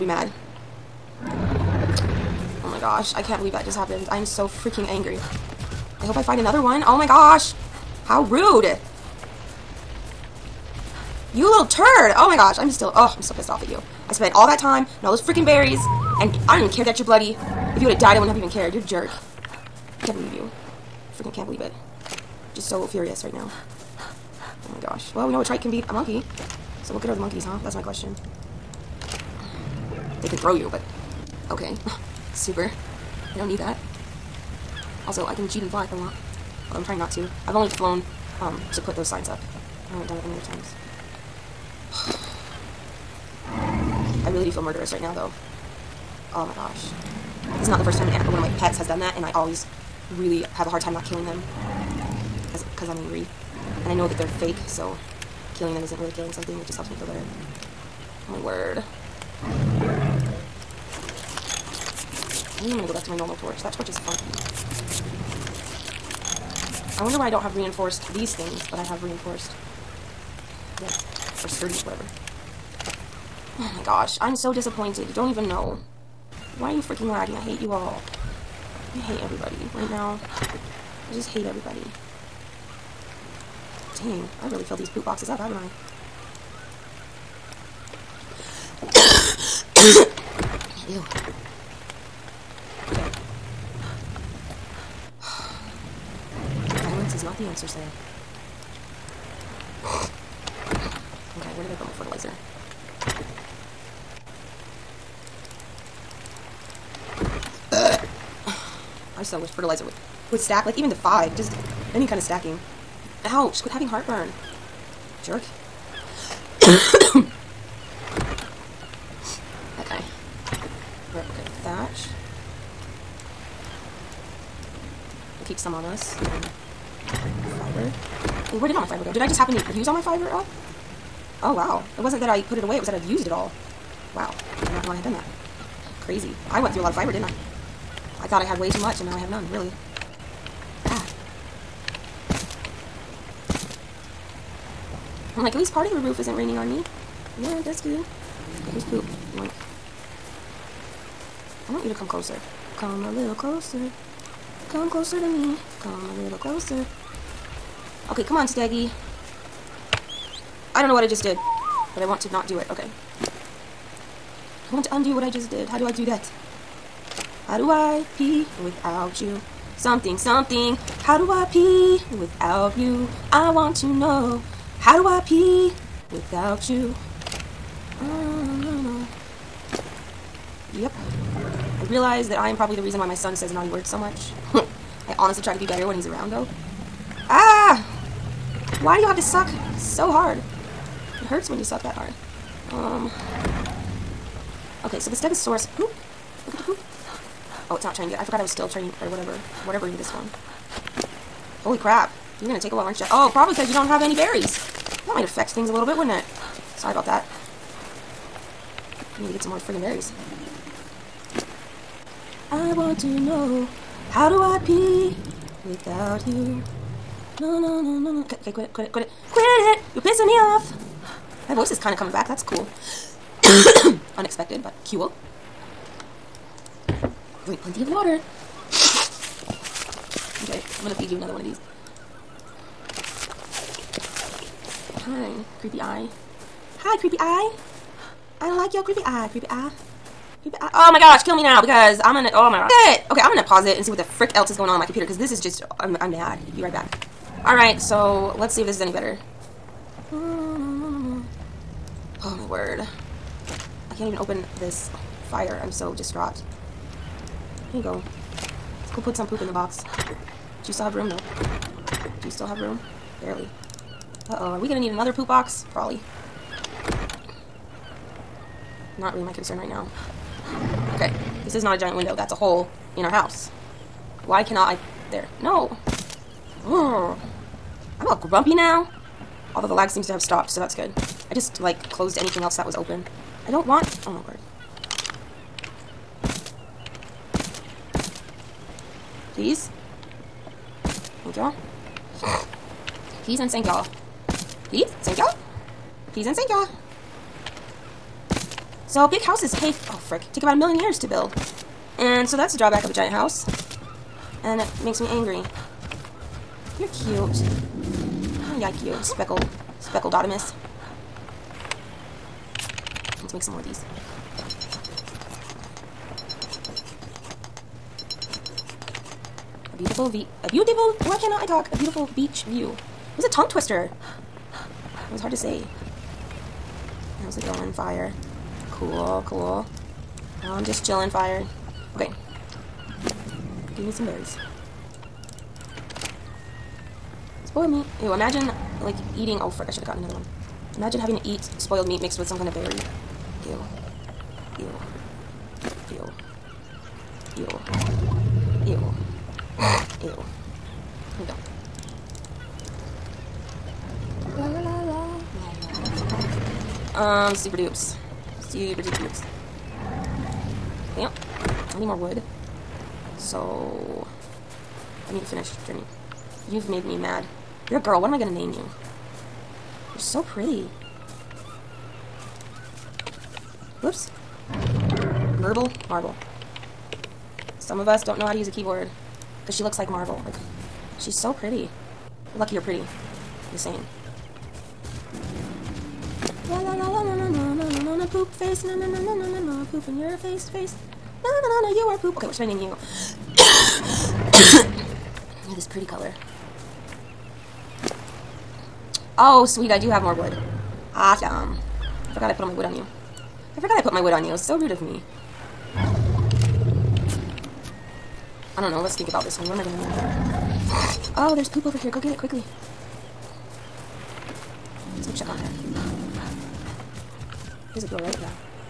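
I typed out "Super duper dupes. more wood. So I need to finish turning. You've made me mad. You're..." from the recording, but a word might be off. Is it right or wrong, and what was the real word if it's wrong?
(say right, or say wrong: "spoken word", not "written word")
right.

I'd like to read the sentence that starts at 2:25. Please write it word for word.
I'm like, at least part of the roof isn't raining on me.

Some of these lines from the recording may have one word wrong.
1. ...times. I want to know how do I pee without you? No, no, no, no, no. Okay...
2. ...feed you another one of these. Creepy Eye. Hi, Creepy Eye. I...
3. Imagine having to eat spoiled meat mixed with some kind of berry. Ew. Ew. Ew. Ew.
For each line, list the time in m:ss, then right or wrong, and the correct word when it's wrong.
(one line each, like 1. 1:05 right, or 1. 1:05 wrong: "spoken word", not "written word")
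1. 3:29 wrong: "berries", not "times"
2. 3:50 right
3. 5:40 right.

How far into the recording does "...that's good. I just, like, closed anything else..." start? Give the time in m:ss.
4:40.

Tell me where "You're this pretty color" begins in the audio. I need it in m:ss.
6:35.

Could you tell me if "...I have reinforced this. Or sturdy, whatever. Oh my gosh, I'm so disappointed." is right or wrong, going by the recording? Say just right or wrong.
right.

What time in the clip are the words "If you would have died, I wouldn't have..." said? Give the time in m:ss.
0:17.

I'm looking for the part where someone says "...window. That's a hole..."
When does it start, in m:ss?
4:31.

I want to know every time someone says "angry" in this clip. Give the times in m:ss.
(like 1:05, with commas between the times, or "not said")
0:04, 0:52, 5:05.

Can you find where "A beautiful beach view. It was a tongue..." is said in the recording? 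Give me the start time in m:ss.
5:21.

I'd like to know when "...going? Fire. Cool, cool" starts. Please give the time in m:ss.
5:27.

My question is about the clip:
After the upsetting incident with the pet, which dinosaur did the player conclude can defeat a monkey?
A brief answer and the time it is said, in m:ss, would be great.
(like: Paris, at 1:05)
Trike, at 0:25.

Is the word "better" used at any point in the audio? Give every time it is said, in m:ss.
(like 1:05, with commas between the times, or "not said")
0:57, 3:05, 4:08.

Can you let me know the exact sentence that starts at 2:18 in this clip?
I thought I had way too much, and now I have none, really.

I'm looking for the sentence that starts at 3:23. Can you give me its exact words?
Oh, probably because you don't have any berries.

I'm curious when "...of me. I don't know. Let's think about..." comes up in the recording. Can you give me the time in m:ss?
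6:44.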